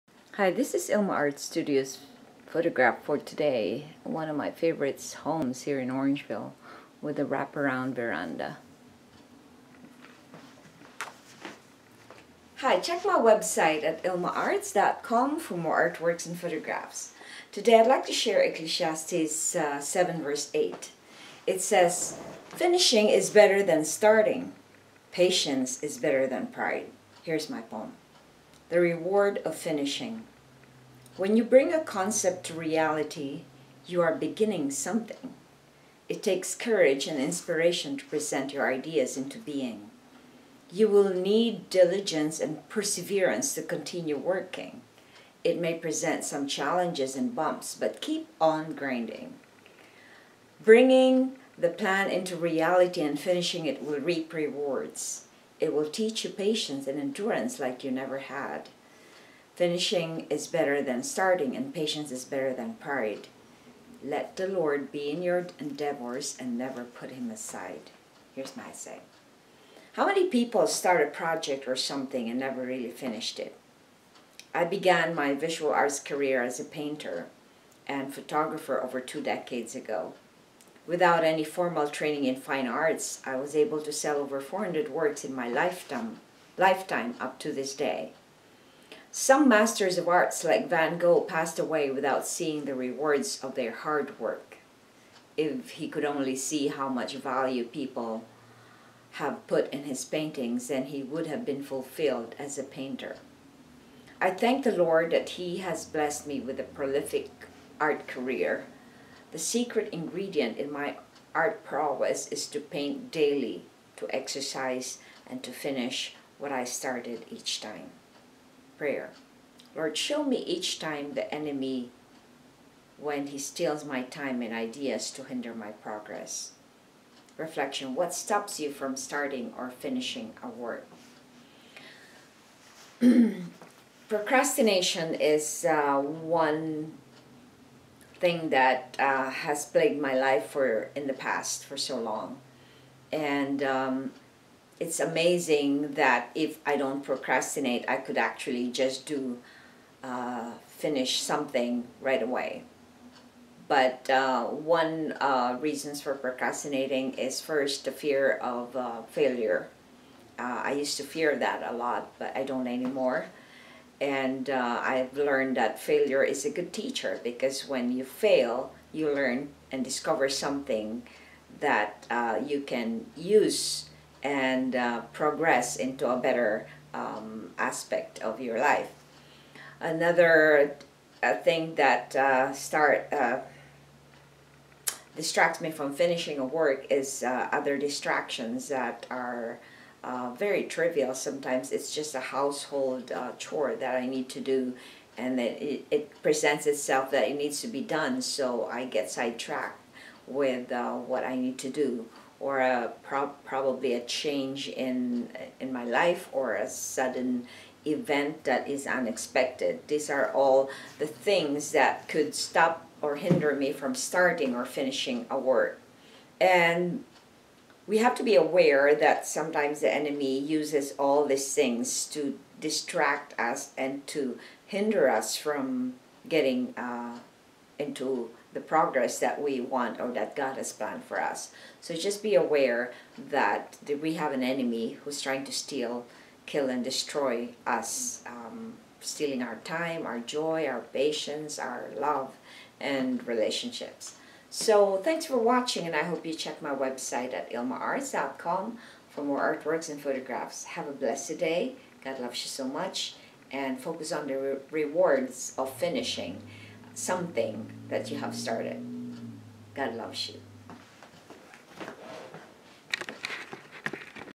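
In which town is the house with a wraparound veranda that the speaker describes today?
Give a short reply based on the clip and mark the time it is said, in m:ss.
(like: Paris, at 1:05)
Orangeville, at 0:05.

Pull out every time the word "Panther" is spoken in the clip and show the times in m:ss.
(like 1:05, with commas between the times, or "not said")
not said.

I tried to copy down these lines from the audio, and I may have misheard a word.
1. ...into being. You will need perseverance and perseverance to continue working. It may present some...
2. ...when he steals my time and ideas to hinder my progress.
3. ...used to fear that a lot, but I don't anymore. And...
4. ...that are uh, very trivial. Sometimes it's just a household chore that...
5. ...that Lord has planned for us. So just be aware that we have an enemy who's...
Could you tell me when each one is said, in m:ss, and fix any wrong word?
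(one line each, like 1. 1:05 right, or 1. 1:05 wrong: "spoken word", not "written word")
1. 0:39 wrong: "diligence", not "perseverance"
2. 2:02 right
3. 2:40 right
4. 3:08 right
5. 3:50 wrong: "God", not "Lord".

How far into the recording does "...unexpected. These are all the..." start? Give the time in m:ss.
3:28.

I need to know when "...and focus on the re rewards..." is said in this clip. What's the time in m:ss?
4:13.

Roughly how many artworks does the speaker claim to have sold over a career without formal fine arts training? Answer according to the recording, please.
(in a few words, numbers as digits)
over 400.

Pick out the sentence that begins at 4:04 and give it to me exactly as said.
So thanks for watching, and I hope you check my website at ilmaarts.com for more artworks and photographs.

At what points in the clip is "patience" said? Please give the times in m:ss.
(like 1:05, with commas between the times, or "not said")
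0:25, 0:56, 1:01, 4:00.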